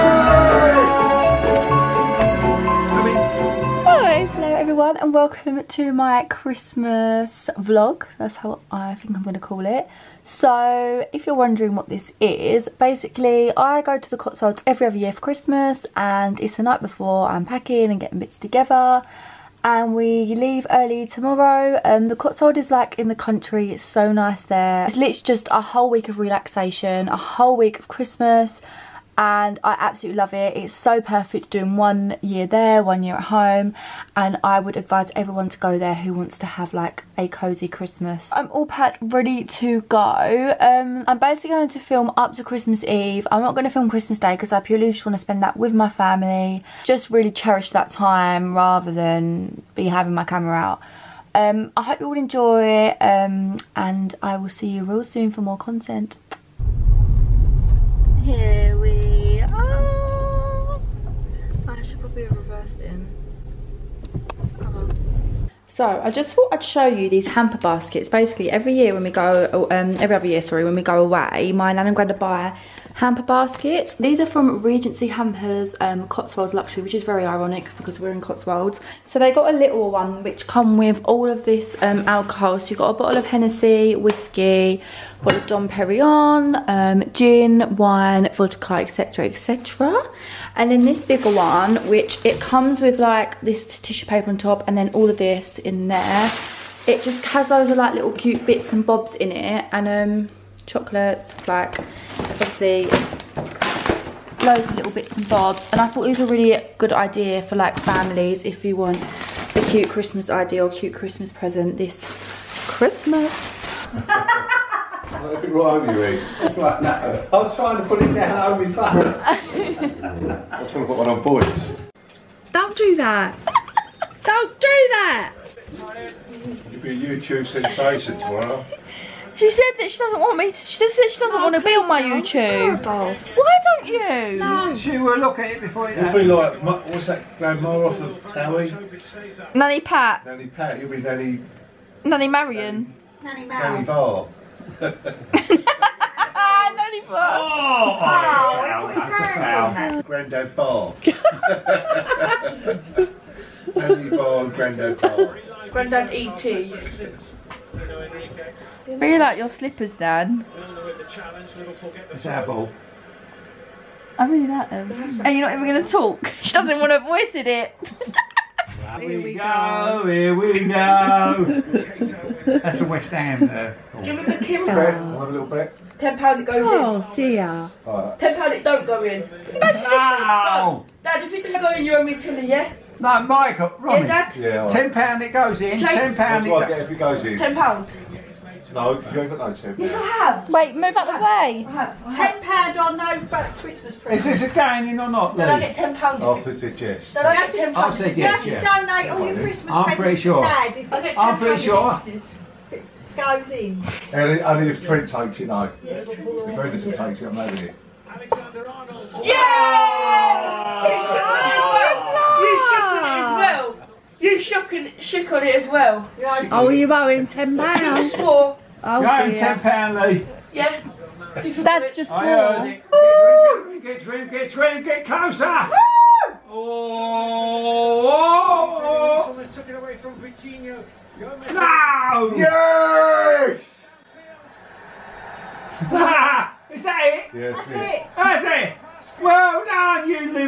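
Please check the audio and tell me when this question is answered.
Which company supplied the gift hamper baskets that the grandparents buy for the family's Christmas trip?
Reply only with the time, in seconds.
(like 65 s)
74 s.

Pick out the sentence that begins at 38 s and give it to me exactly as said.
I'm all packed ready to go.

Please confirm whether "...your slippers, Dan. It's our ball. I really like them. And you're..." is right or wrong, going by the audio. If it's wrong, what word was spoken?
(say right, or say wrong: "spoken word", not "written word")
right.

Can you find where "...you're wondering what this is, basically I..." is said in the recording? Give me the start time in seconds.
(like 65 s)
11 s.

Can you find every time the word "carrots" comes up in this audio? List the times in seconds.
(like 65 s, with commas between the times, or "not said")
not said.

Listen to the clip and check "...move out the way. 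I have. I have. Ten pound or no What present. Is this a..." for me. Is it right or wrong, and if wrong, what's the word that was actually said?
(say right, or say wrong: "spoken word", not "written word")
wrong: "Christmas", not "What".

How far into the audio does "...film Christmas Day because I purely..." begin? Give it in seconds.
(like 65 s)
43 s.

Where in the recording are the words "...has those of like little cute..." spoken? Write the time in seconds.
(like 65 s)
97 s.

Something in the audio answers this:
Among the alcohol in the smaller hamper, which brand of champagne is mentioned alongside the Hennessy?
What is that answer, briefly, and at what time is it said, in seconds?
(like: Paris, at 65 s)
Dom Perignon, at 85 s.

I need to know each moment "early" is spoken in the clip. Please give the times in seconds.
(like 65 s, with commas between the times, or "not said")
20 s.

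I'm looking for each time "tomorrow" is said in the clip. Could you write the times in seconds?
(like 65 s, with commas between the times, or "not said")
21 s, 128 s.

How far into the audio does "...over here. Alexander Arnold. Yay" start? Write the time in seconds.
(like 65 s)
207 s.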